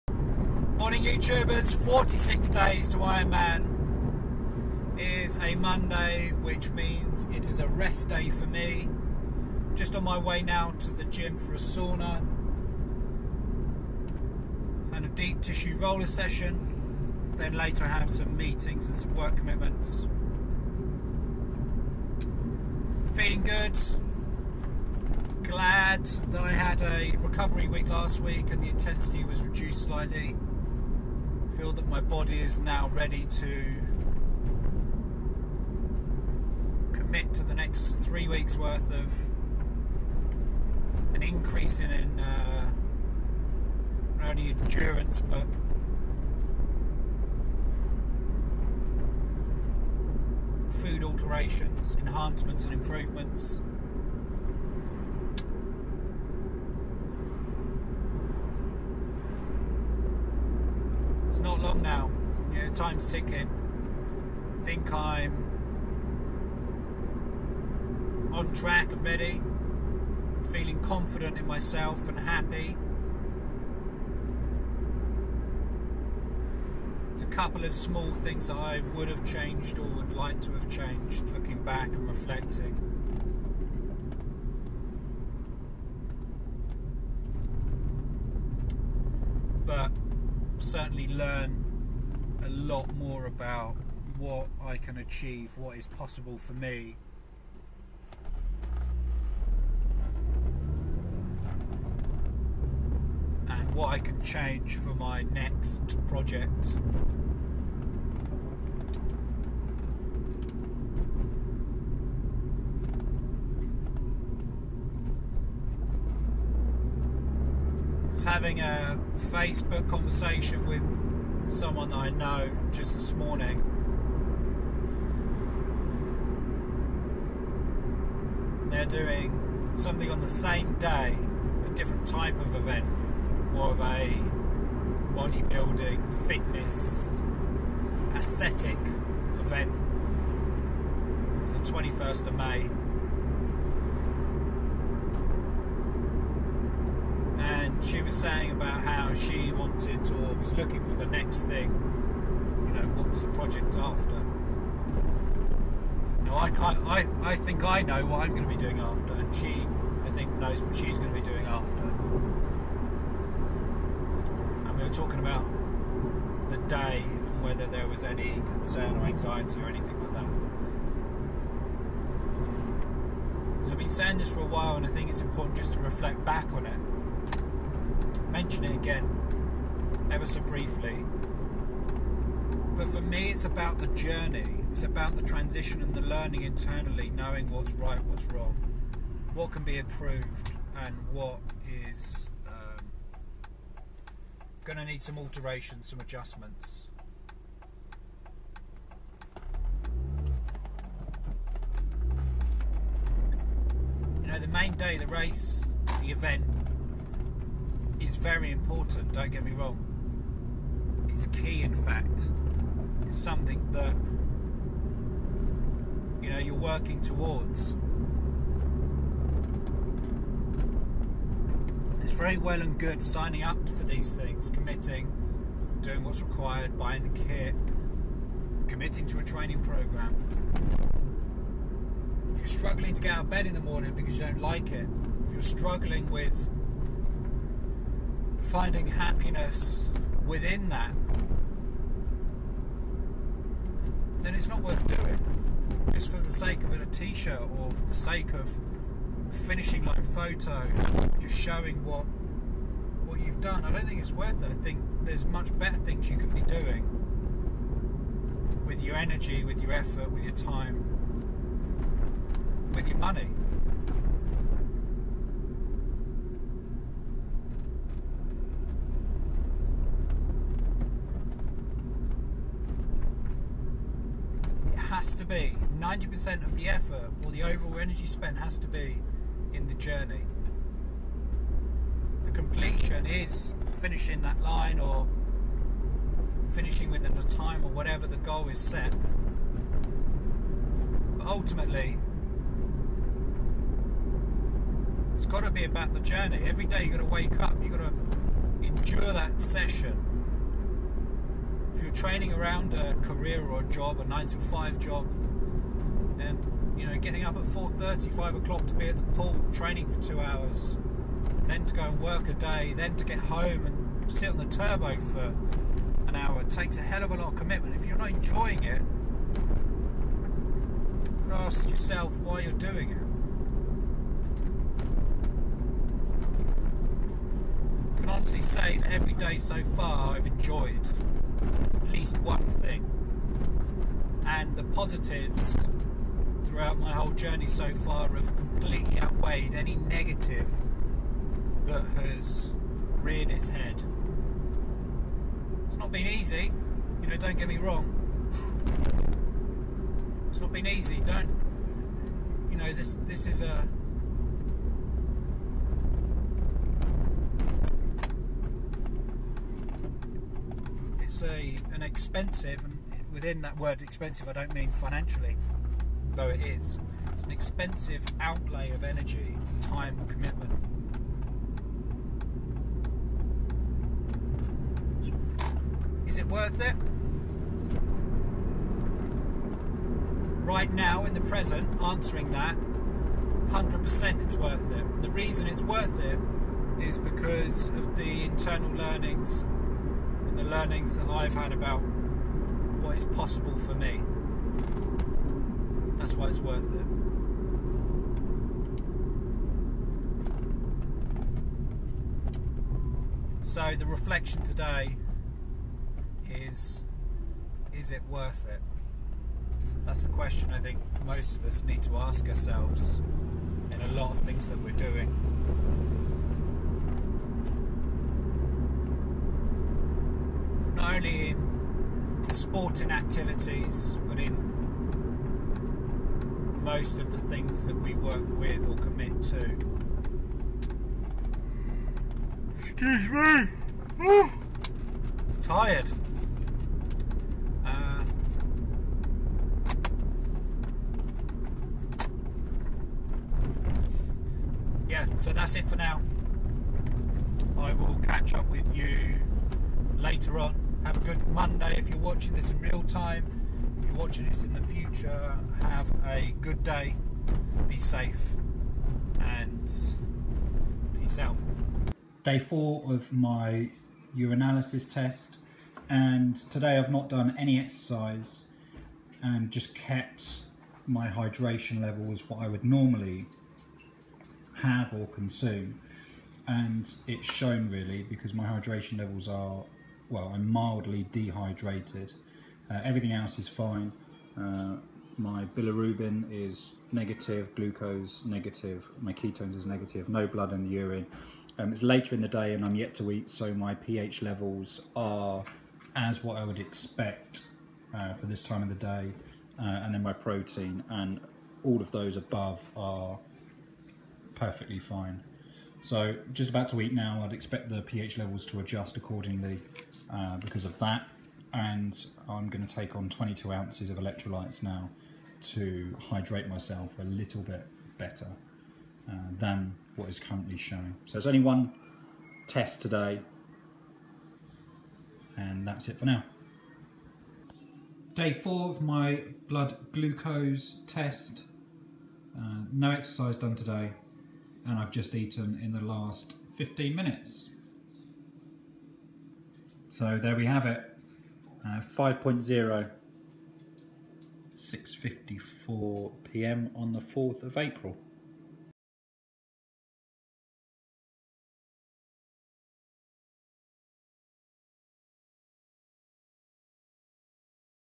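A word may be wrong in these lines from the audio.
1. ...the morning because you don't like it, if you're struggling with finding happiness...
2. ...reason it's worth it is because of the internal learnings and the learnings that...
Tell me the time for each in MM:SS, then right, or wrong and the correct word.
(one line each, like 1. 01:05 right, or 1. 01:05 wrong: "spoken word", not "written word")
1. 03:53 right
2. 06:25 right.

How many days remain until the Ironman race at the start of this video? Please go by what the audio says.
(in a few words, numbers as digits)
46.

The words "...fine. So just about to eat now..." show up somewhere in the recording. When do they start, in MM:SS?
08:24.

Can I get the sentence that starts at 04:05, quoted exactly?
Just for the sake of a t shirt or the sake of finishing like a photo, just showing what what you've done.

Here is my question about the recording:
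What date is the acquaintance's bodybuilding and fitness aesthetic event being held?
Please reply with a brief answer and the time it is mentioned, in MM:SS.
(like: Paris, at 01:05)
21st of May, at 02:21.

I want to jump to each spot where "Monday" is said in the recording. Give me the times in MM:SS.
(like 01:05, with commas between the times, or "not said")
00:05, 07:31.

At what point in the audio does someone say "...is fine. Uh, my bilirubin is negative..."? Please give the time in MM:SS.
08:03.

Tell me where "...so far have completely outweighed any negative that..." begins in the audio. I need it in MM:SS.
05:37.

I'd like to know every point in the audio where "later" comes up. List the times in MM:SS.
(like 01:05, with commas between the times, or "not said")
00:17, 07:29, 08:11.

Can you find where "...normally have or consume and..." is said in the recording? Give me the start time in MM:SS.
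07:52.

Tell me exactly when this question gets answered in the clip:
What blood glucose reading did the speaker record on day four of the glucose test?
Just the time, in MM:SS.
09:01.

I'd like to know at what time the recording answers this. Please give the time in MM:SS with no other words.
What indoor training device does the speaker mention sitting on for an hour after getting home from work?
05:14.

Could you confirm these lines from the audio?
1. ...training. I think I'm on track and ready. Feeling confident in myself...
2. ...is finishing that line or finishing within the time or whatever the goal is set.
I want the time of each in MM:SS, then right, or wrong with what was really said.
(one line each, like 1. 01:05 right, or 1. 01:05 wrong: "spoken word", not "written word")
1. 01:03 wrong: "ticking", not "training"
2. 04:43 right.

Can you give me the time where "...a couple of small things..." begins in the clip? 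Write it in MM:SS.
01:17.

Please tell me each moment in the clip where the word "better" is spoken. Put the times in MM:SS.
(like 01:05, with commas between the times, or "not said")
04:15, 08:37.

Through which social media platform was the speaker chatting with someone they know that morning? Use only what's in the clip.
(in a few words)
Facebook.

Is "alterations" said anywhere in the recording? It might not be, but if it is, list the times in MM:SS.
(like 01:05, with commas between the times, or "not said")
00:51, 03:15.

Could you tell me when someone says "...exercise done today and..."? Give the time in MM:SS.
08:52.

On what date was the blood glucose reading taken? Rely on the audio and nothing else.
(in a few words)
4th of April.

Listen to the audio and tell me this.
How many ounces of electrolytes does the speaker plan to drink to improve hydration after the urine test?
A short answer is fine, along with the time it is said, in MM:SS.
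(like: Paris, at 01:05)
22, at 08:33.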